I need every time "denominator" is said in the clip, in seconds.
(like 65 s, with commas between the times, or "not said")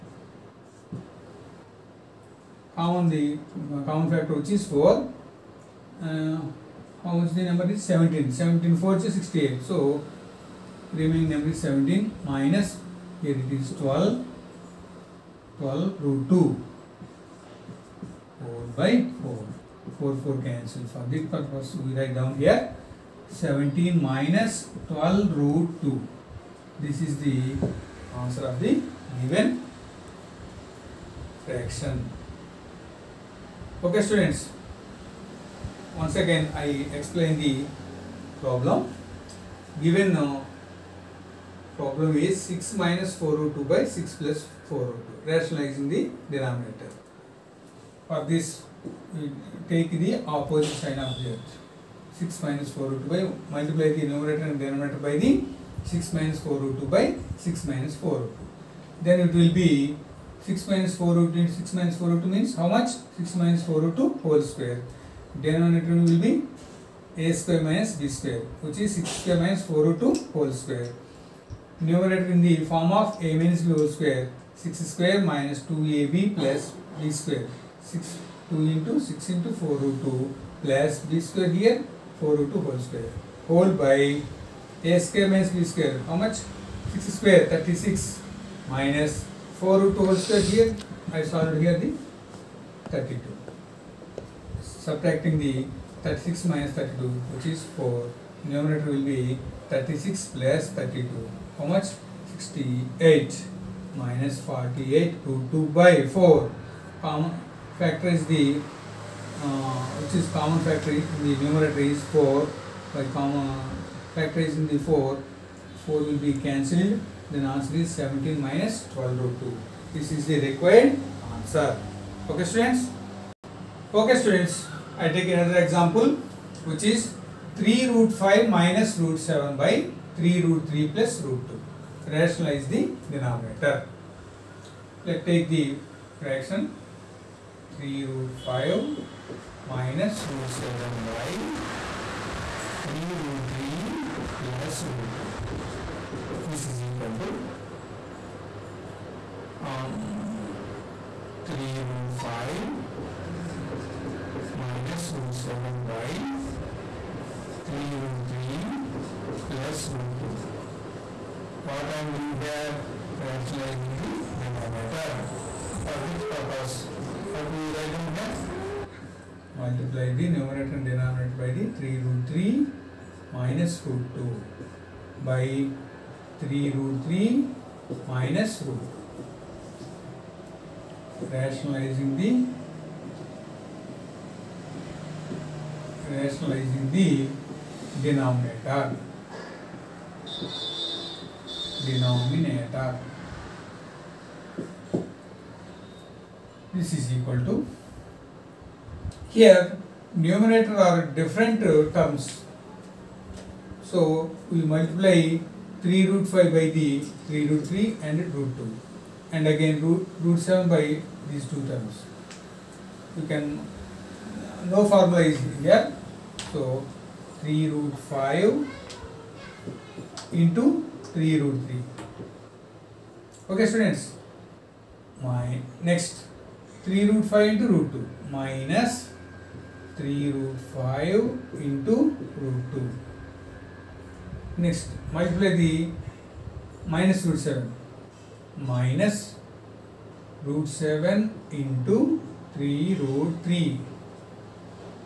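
46 s, 54 s, 65 s, 133 s, 164 s, 170 s, 188 s.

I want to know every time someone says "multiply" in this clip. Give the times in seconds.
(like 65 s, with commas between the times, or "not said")
53 s, 169 s, 204 s, 235 s.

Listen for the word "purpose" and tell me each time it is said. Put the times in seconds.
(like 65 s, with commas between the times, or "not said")
21 s, 166 s.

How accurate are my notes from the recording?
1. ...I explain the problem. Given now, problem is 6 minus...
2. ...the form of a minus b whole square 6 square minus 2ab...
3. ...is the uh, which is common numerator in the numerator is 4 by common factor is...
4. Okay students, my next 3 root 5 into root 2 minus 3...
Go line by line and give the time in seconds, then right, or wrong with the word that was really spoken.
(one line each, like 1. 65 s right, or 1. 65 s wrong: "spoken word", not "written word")
1. 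36 s right
2. 72 s right
3. 108 s wrong: "factor", not "numerator"
4. 223 s right.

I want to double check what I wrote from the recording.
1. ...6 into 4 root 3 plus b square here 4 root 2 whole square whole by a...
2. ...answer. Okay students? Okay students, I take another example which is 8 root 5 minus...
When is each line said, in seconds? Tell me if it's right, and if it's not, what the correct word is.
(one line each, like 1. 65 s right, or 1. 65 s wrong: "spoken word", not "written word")
1. 79 s wrong: "2", not "3"
2. 121 s wrong: "3", not "8".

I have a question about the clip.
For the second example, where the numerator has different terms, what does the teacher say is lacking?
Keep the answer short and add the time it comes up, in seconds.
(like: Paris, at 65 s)
no formula, at 214 s.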